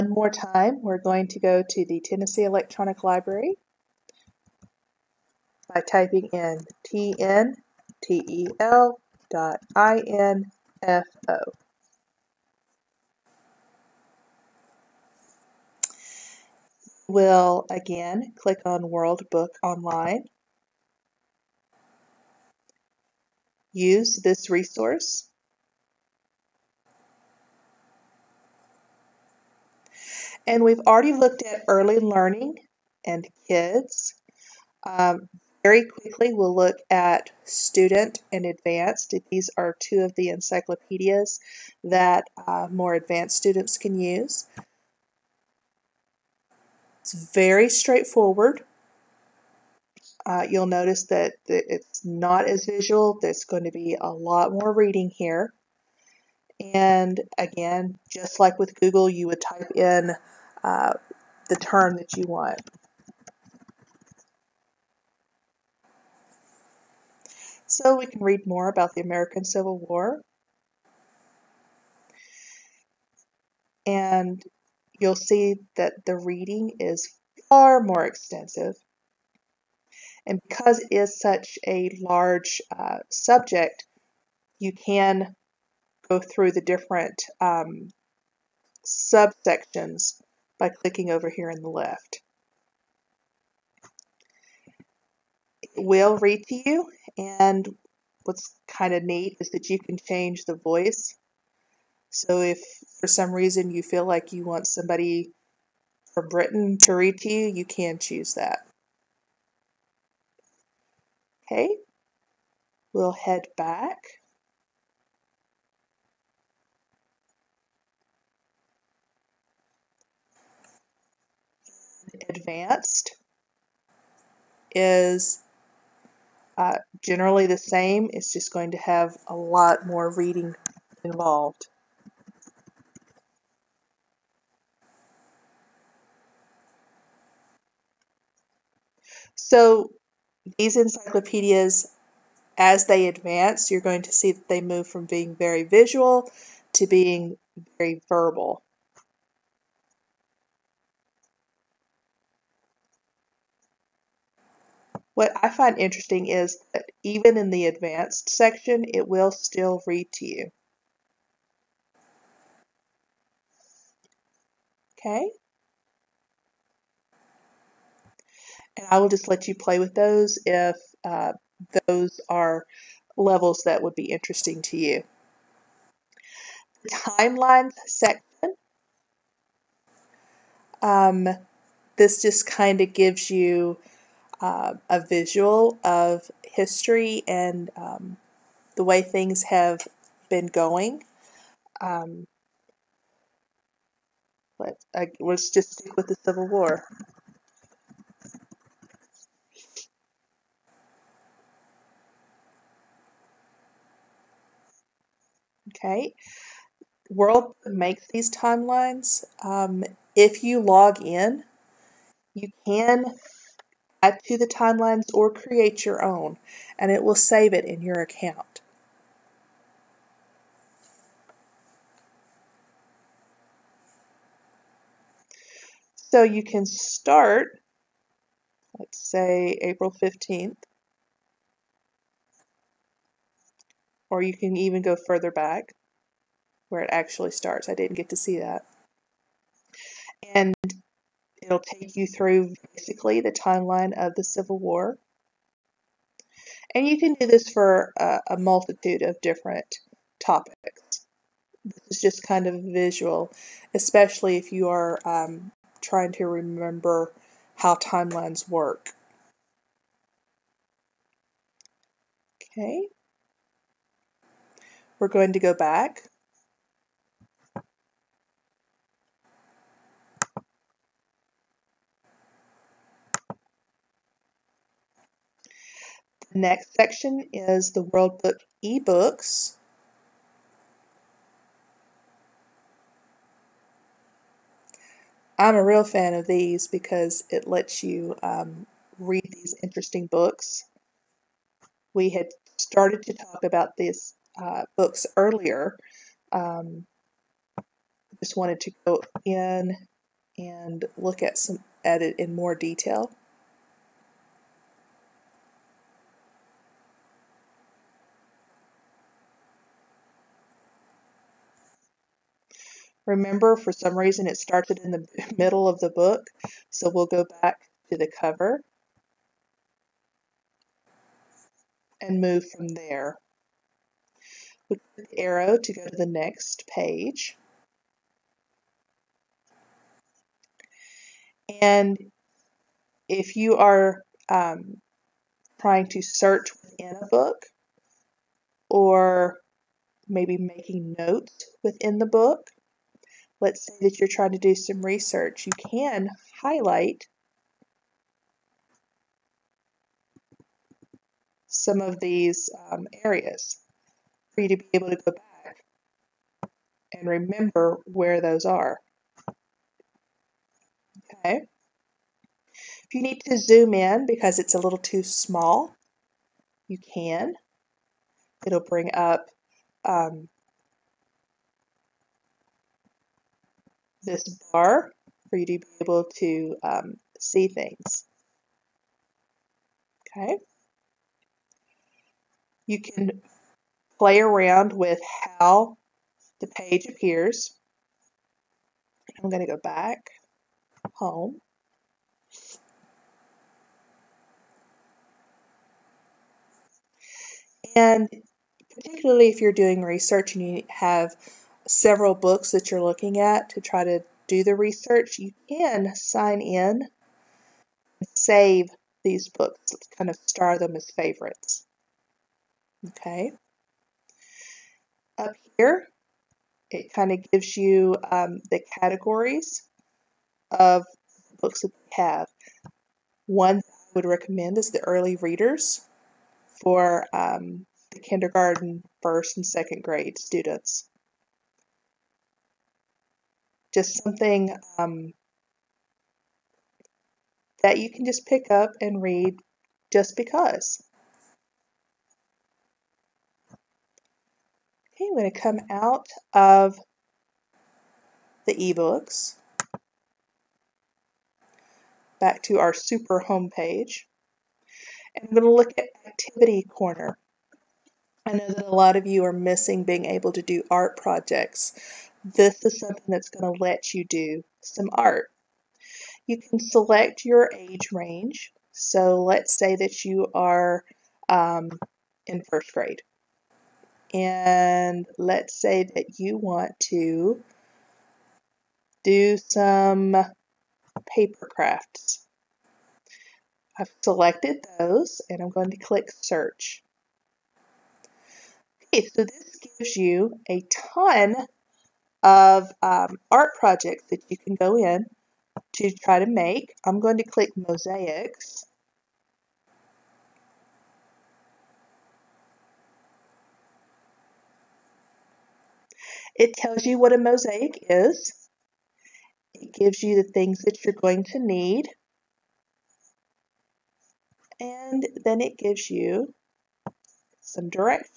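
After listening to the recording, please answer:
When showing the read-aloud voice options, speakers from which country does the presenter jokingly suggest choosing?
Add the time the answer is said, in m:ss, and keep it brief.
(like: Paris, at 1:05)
Britain, at 1:46.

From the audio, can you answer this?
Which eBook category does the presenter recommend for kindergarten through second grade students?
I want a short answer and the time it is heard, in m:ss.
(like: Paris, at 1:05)
early readers, at 7:04.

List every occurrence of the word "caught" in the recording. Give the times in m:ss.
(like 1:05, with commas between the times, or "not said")
not said.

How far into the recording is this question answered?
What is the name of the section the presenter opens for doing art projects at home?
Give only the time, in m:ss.
7:36.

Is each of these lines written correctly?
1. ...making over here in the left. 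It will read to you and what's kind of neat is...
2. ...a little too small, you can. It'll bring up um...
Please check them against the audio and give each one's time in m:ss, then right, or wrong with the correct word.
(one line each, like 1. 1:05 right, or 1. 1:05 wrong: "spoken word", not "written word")
1. 1:30 wrong: "clicking", not "making"
2. 6:04 right.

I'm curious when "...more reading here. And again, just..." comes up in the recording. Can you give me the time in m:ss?
0:54.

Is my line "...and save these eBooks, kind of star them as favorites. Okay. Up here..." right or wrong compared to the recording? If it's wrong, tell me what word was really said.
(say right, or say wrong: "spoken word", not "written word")
wrong: "books", not "eBooks".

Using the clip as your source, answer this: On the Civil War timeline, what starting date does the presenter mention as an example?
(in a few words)
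April 15th.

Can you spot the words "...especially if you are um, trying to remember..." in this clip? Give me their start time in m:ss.
4:13.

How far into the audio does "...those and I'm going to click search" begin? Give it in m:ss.
8:04.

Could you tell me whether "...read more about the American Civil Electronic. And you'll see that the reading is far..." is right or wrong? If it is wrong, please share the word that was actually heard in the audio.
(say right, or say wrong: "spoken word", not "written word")
wrong: "War", not "Electronic".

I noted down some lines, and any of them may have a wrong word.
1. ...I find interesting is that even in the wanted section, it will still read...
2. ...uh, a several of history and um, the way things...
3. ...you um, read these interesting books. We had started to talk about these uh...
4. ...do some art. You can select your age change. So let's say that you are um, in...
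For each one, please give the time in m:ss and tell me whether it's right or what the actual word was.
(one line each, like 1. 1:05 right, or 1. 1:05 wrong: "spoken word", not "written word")
1. 2:35 wrong: "advanced", not "wanted"
2. 3:04 wrong: "visual", not "several"
3. 4:47 right
4. 7:44 wrong: "range", not "change".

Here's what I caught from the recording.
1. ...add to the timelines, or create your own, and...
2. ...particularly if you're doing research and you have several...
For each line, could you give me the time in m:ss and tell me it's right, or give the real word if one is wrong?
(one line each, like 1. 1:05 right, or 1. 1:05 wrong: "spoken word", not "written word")
1. 3:34 right
2. 6:38 right.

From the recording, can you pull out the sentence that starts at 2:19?
So these encyclopedias, as they advance, you're going to see that they move from being very visual to being very verbal.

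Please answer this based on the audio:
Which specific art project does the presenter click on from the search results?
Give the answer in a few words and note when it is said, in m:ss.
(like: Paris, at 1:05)
mosaics, at 8:17.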